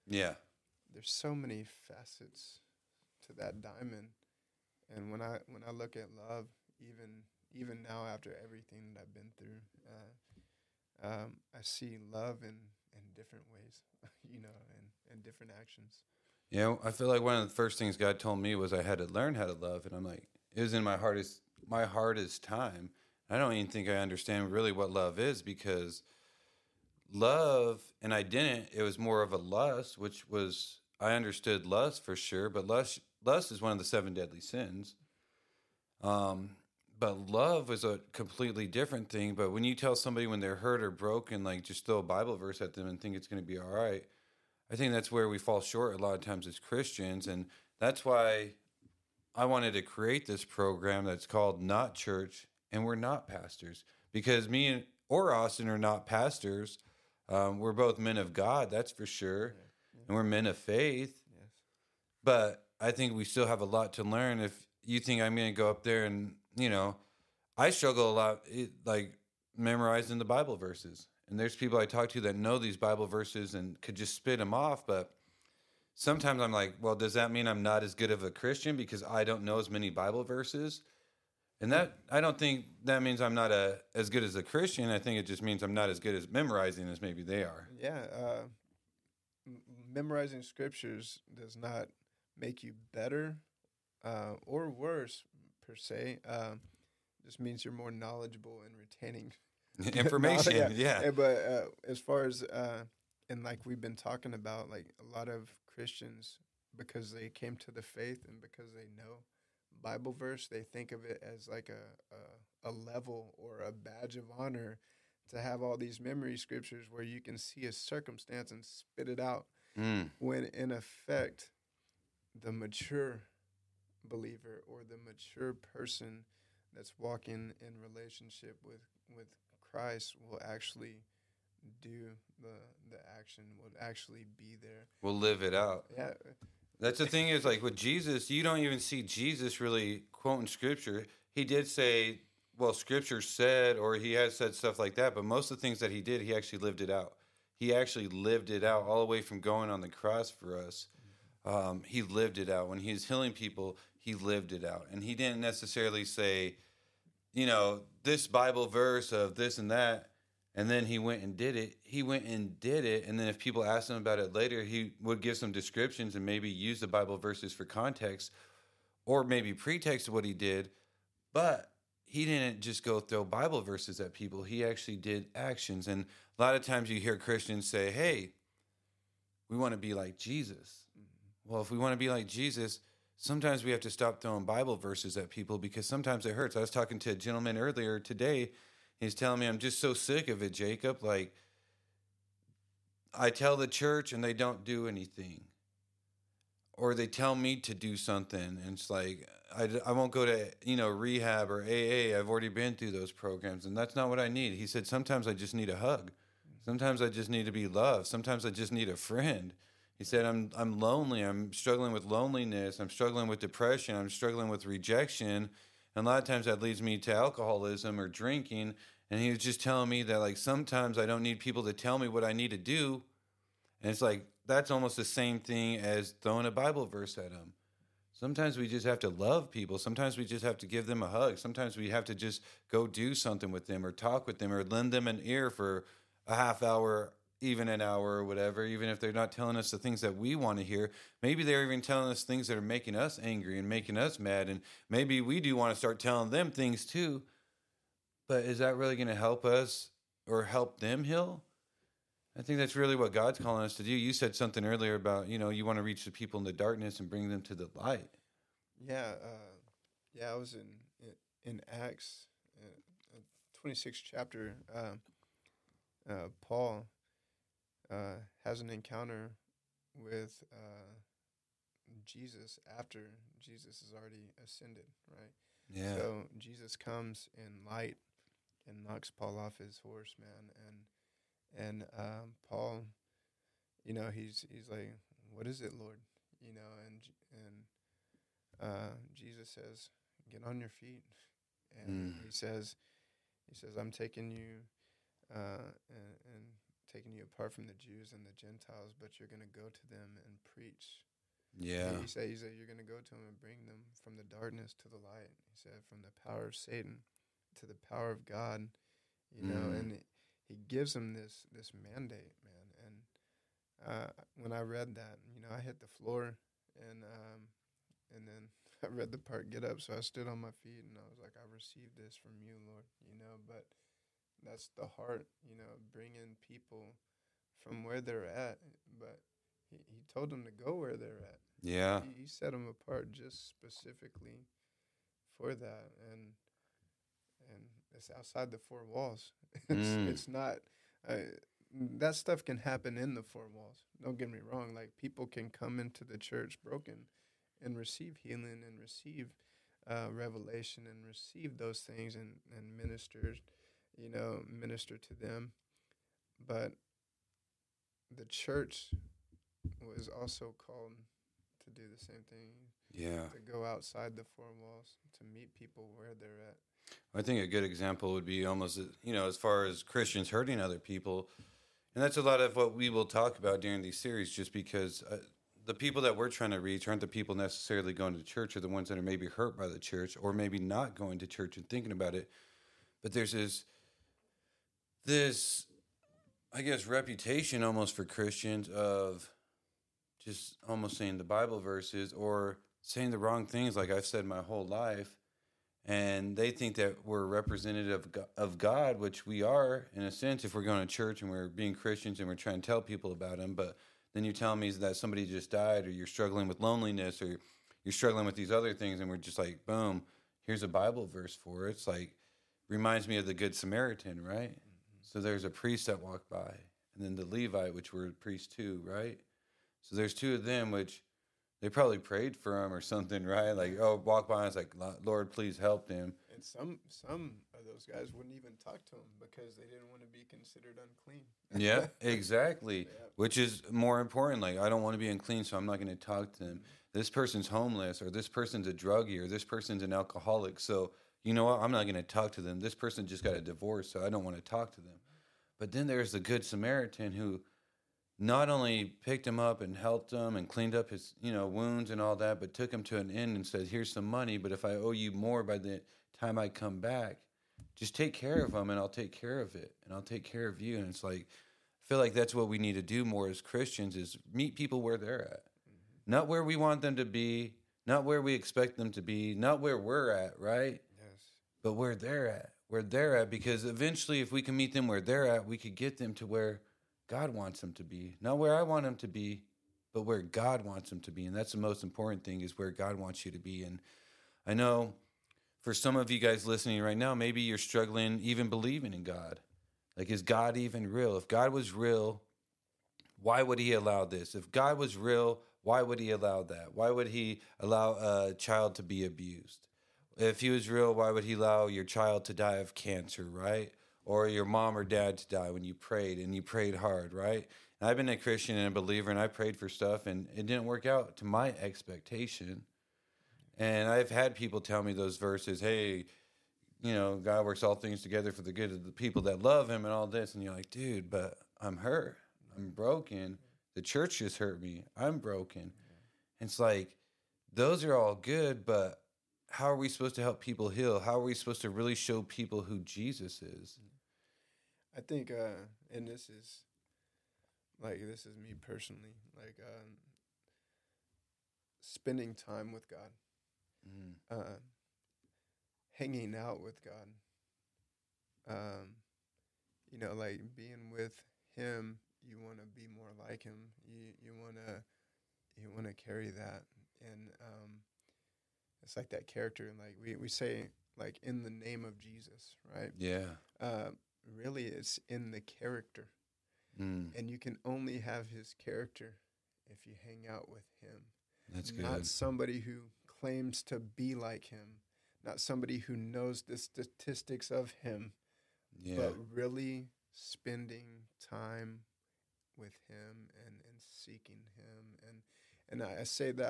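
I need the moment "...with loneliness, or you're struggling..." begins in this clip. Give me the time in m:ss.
6:46.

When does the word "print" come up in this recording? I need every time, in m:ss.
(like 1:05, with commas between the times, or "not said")
not said.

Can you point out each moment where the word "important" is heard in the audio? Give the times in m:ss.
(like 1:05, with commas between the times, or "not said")
7:13, 8:01.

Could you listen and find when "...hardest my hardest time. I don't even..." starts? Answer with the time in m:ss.
0:20.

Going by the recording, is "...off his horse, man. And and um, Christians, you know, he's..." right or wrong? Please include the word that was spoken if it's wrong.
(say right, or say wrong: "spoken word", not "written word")
wrong: "Paul", not "Christians".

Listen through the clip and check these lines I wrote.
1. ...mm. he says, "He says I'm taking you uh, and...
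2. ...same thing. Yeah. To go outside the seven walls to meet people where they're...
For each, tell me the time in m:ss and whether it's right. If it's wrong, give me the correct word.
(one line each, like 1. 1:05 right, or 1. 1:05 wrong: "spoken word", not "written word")
1. 4:52 right
2. 6:02 wrong: "four", not "seven".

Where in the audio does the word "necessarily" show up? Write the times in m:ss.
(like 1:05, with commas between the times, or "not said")
2:35, 6:17.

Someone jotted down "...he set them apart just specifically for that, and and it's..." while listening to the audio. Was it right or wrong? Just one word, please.
right.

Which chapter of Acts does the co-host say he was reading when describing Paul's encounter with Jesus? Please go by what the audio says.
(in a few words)
26.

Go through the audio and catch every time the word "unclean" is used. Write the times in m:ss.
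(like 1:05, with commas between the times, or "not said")
7:10, 7:15.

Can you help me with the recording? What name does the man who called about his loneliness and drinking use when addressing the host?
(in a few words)
Jacob.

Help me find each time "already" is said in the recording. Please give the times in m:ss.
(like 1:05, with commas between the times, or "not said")
3:22, 4:33.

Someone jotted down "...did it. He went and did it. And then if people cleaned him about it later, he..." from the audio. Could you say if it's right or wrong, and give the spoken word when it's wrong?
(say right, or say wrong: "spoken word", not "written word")
wrong: "asked", not "cleaned".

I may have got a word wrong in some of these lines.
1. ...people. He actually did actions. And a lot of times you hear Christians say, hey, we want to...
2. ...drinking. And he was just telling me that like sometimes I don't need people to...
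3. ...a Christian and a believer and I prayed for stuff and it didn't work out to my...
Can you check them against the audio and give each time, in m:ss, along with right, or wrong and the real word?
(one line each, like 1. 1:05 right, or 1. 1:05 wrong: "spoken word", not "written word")
1. 2:54 right
2. 3:38 right
3. 8:28 right.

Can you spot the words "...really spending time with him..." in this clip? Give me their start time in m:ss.
9:39.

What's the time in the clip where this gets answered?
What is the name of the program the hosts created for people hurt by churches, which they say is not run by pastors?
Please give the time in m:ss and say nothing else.
0:51.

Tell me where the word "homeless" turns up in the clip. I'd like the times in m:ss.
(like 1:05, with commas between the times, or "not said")
7:17.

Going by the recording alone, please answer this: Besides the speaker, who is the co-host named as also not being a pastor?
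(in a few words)
Austin.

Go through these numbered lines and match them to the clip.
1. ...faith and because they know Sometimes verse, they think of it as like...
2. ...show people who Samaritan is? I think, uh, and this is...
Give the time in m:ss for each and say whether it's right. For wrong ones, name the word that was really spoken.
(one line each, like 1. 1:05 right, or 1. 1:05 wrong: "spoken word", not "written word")
1. 1:47 wrong: "Bible", not "Sometimes"
2. 8:51 wrong: "Jesus", not "Samaritan".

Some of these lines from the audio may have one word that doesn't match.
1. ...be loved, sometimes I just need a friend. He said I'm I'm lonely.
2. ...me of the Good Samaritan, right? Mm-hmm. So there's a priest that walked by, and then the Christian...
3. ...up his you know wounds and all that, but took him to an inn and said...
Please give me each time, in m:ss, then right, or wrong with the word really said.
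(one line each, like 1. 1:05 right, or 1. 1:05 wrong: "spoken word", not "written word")
1. 3:27 right
2. 6:53 wrong: "Levite", not "Christian"
3. 7:30 right.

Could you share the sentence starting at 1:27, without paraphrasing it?
Yeah, uh, memorizing scriptures does not make you better uh, or worse per se.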